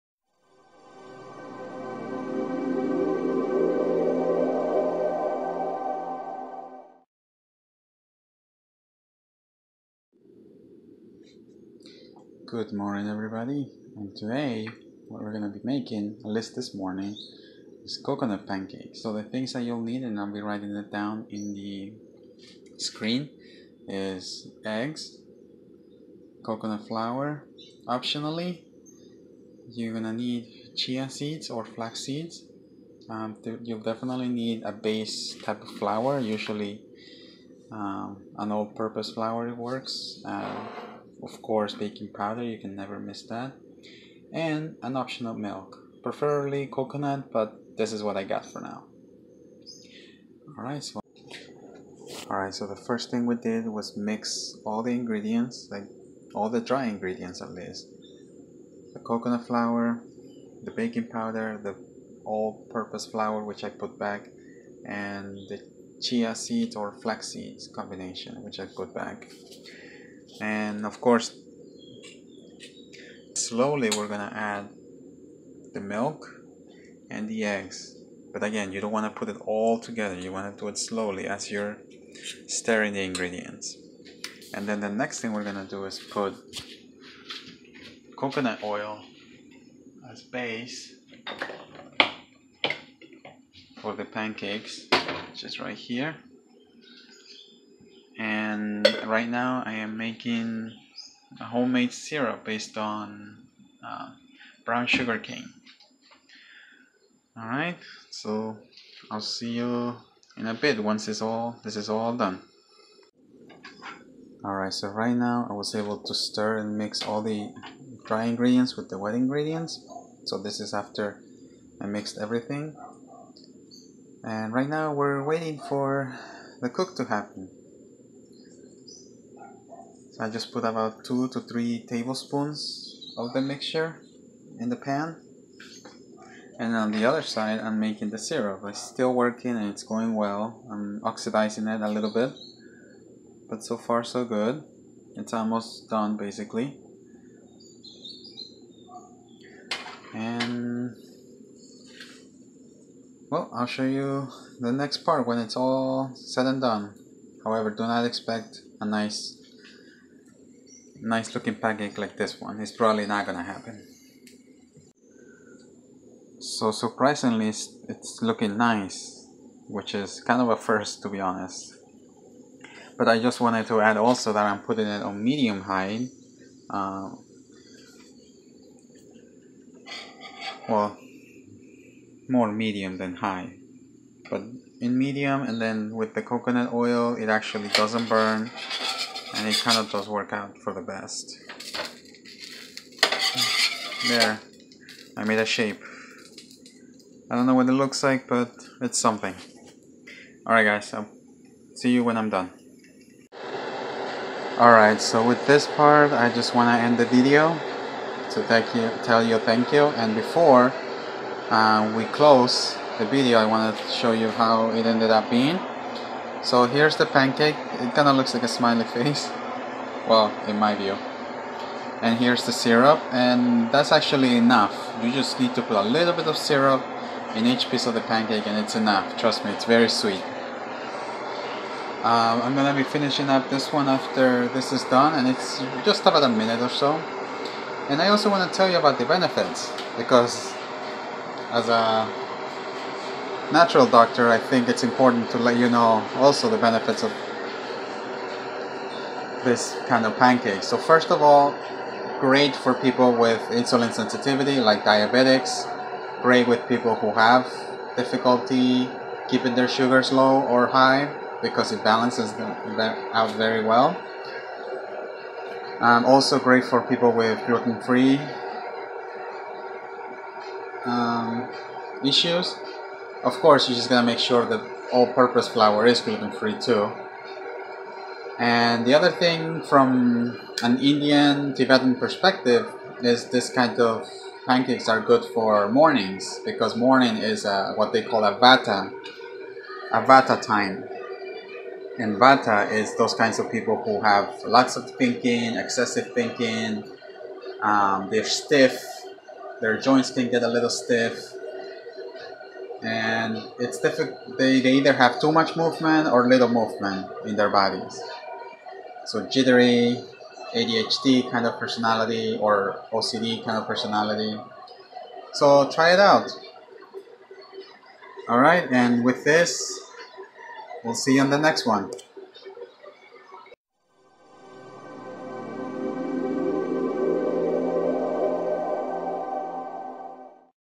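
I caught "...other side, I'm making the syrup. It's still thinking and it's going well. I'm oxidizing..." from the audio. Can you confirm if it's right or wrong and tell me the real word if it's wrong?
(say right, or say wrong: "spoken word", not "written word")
wrong: "working", not "thinking".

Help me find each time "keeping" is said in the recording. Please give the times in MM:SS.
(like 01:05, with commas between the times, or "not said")
04:19.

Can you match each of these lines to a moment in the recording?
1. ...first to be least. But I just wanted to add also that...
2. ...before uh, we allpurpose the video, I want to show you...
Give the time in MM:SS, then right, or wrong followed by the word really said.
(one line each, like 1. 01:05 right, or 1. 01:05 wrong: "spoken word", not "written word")
1. 02:50 wrong: "honest", not "least"
2. 03:30 wrong: "close", not "allpurpose".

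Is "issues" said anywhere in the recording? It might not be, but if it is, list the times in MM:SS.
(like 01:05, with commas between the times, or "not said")
04:32.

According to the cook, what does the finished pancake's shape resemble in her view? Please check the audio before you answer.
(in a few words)
a smiley face.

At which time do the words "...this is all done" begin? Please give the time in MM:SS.
01:51.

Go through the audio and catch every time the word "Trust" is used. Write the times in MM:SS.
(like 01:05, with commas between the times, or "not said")
03:49.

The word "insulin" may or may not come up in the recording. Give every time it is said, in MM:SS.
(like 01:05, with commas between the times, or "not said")
04:13.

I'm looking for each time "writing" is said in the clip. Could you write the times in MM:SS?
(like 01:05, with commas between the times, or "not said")
00:20.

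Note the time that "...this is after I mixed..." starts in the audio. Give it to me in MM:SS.
02:00.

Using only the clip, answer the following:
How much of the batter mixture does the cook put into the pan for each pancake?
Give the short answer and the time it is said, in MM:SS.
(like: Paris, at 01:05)
2 to 3 tablespoons, at 02:11.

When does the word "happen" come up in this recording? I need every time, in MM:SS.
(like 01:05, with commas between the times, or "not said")
02:07, 02:43.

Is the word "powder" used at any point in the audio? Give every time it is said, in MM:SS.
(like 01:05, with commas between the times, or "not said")
00:42, 01:01.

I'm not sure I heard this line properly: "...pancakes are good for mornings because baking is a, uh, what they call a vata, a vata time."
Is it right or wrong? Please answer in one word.
wrong.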